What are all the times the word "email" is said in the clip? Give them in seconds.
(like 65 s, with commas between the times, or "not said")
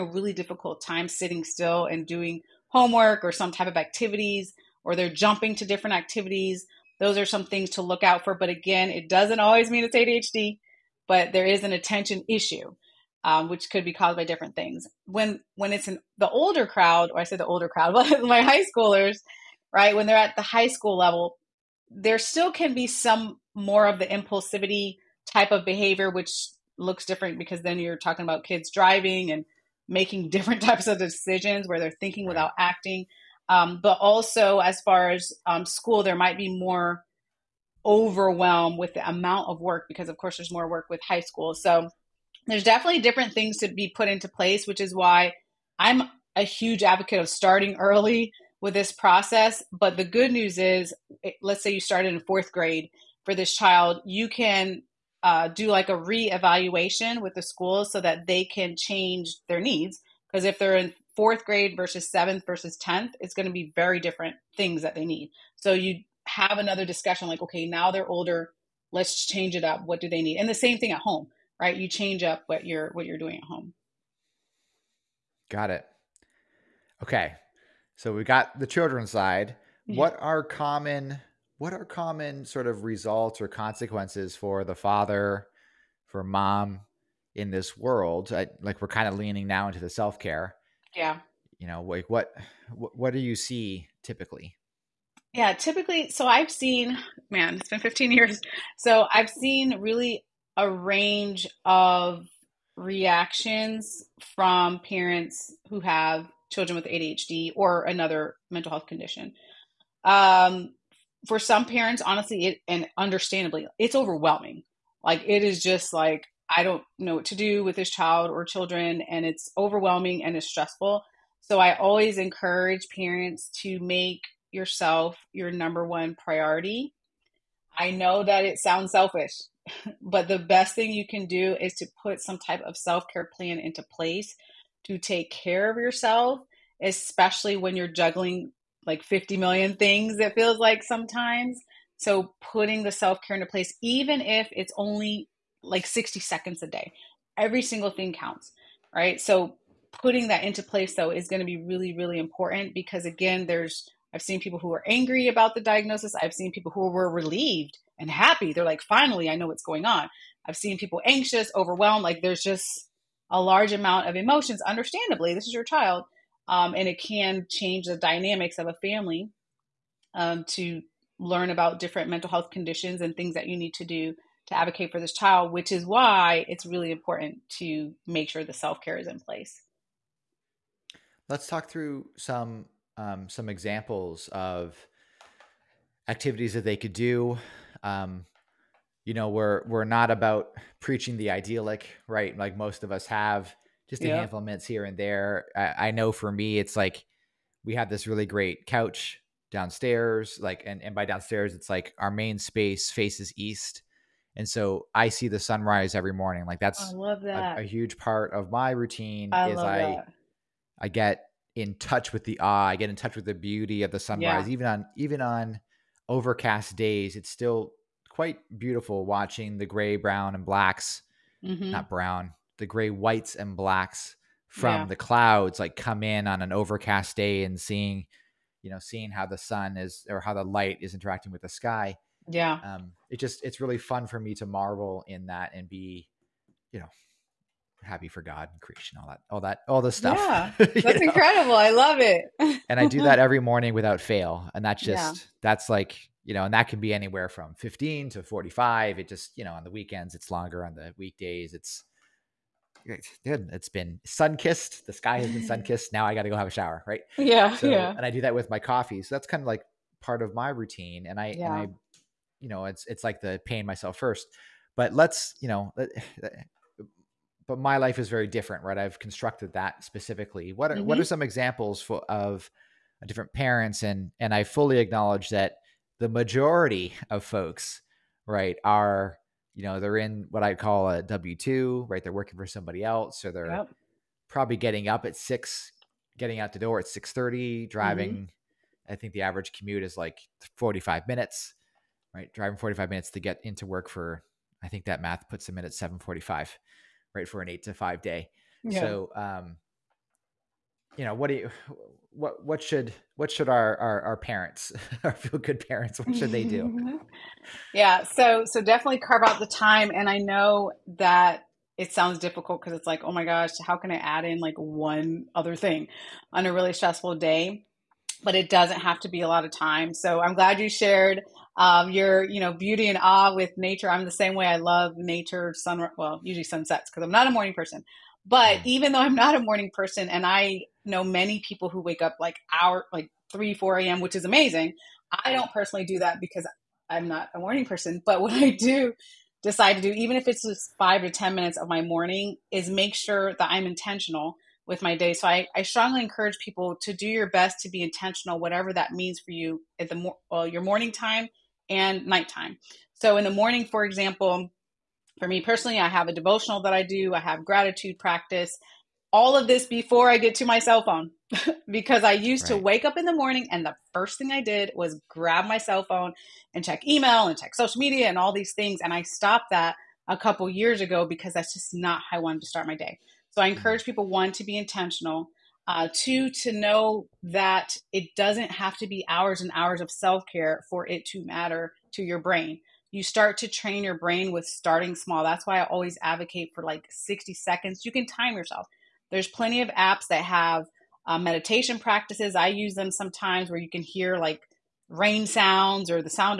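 366 s.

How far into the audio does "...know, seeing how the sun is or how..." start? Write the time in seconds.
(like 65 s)
228 s.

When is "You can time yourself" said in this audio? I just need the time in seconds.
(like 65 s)
387 s.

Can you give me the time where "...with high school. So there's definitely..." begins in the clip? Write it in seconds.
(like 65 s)
40 s.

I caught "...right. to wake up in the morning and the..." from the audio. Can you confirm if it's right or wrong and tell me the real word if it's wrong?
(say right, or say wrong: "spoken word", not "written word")
right.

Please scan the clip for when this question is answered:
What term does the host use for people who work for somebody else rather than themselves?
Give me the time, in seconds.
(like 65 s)
281 s.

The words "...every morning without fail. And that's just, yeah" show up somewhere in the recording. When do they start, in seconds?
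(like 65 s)
243 s.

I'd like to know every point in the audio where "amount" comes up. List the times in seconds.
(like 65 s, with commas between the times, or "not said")
39 s, 163 s.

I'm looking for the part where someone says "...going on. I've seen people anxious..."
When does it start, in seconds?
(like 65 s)
159 s.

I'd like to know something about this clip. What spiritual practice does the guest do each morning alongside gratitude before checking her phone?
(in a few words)
A devotional.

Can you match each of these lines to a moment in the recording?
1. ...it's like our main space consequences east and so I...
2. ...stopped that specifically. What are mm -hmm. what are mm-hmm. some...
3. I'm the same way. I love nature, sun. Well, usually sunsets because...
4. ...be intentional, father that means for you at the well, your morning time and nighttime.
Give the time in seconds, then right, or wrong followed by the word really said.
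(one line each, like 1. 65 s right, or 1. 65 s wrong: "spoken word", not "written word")
1. 201 s wrong: "faces", not "consequences"
2. 268 s wrong: "constructed", not "stopped"
3. 323 s right
4. 347 s wrong: "whatever", not "father".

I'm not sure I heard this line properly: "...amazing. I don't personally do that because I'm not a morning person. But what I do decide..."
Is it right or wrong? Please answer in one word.
right.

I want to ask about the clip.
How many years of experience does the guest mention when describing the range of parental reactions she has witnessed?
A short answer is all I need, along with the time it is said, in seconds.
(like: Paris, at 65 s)
15 years, at 97 s.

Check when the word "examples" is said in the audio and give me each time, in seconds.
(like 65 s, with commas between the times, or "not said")
183 s, 271 s, 353 s.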